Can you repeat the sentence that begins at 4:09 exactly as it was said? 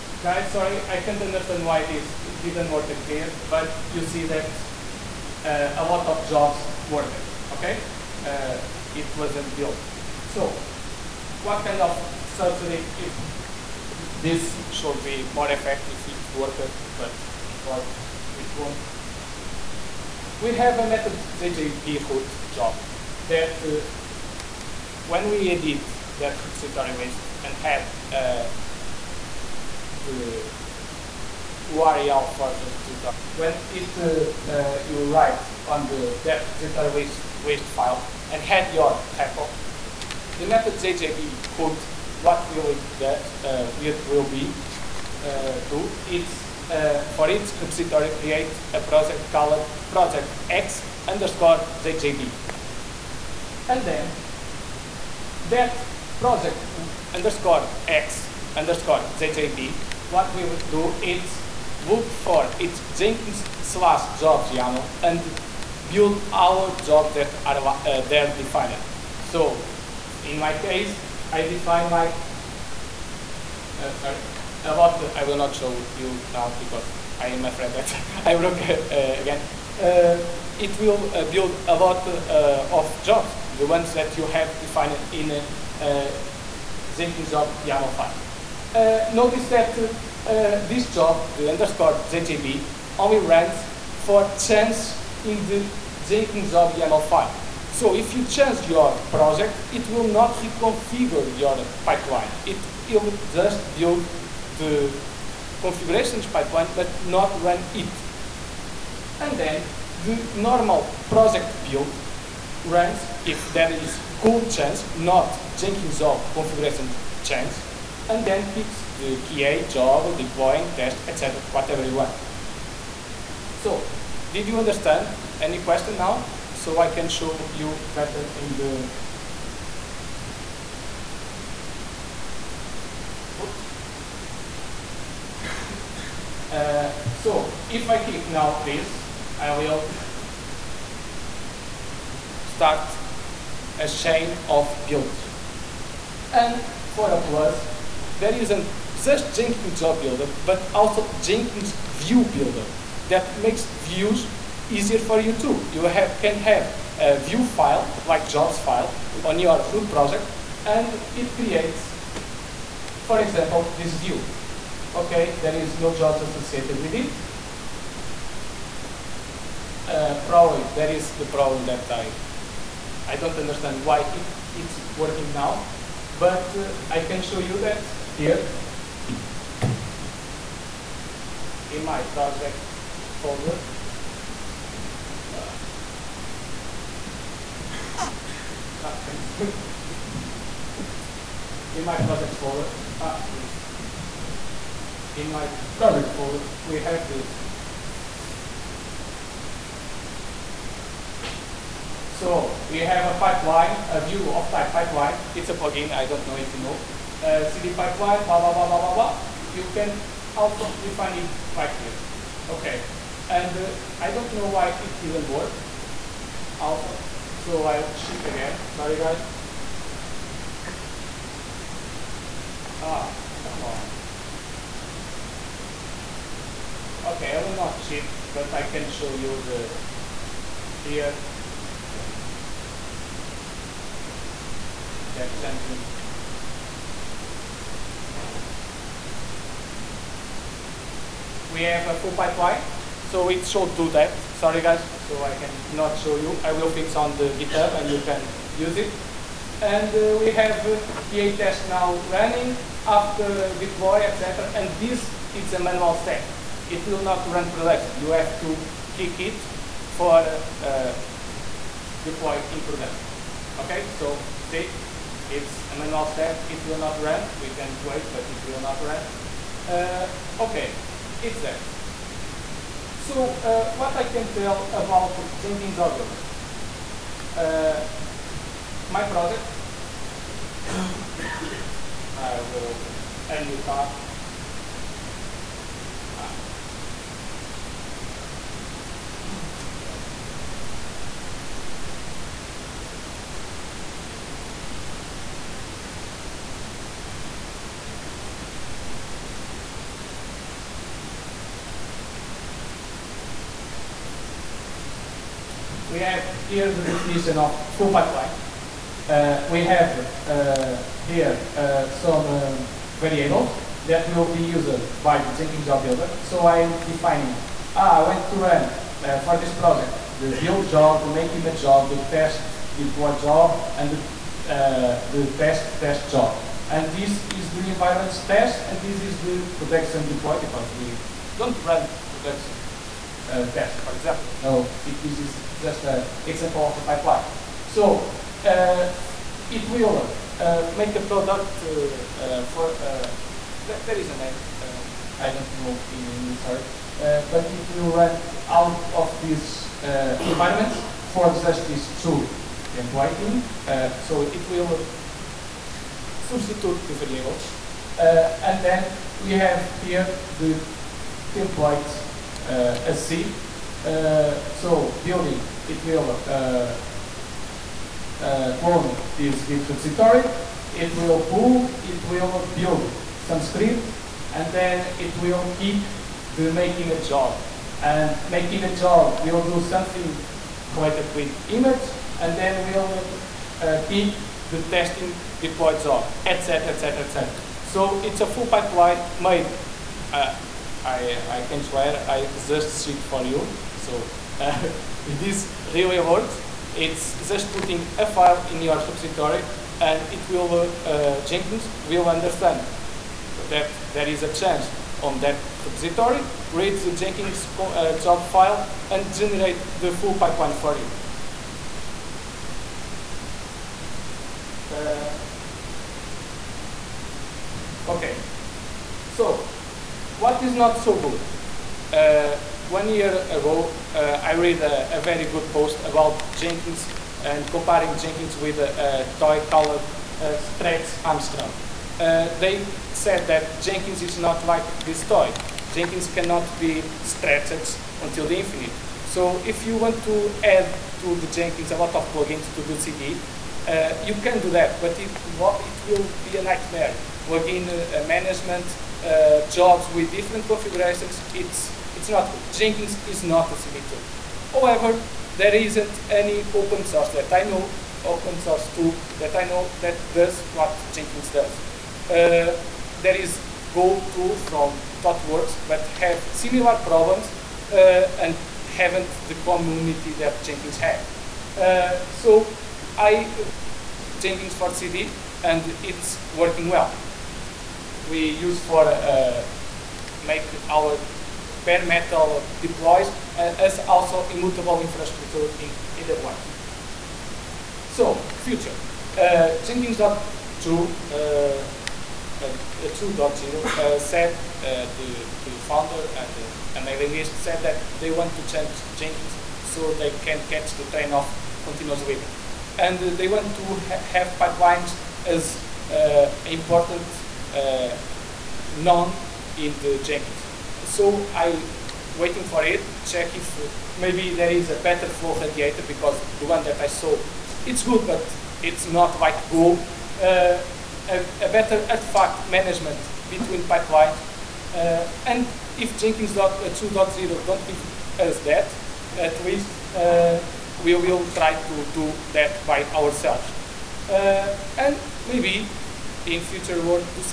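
And uh, we have PA uh, test now running after deploy, etc.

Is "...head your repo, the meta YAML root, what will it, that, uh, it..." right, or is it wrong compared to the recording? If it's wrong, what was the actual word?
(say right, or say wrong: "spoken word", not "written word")
wrong: "JJB", not "YAML".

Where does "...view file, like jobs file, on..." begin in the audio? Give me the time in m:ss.
2:37.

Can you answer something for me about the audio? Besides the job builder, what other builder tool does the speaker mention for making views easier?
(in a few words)
Jenkins view builder.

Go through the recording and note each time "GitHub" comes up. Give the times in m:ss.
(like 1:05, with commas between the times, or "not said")
4:07.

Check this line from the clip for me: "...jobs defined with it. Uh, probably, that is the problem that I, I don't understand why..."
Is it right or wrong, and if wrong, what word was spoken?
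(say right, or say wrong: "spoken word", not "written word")
wrong: "associated", not "defined".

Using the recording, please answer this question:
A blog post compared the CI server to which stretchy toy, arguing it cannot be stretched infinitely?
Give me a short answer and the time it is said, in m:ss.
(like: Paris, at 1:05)
Stretch Armstrong, at 7:10.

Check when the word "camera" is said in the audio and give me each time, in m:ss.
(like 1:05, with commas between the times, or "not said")
not said.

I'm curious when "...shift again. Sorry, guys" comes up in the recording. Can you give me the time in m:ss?
3:37.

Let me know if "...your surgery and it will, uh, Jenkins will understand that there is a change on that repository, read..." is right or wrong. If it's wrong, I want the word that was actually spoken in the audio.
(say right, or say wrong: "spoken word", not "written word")
wrong: "repository", not "surgery".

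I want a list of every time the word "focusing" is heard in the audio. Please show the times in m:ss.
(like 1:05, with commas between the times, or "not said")
not said.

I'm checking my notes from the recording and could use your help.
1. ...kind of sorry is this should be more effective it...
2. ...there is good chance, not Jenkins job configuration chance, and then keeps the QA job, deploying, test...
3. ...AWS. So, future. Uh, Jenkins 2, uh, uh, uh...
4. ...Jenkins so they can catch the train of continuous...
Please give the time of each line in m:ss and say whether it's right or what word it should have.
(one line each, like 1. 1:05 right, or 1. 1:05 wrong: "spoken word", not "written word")
1. 0:11 wrong: "surgery", not "sorry"
2. 1:53 right
3. 8:05 right
4. 8:18 right.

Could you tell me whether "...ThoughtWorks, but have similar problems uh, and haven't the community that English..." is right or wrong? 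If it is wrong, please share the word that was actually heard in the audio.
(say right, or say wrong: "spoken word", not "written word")
wrong: "Jenkins", not "English".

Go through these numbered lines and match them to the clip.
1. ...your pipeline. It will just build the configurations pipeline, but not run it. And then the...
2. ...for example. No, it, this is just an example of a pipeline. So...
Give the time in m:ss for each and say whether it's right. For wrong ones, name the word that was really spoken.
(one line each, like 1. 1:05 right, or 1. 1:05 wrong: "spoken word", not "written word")
1. 1:41 right
2. 5:33 right.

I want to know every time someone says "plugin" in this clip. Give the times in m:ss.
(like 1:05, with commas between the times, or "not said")
3:25, 7:22, 7:27.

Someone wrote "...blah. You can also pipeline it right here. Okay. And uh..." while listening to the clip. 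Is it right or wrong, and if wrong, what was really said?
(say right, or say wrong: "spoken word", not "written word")
wrong: "define", not "pipeline".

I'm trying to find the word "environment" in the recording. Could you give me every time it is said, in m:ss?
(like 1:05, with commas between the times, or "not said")
5:27, 5:50.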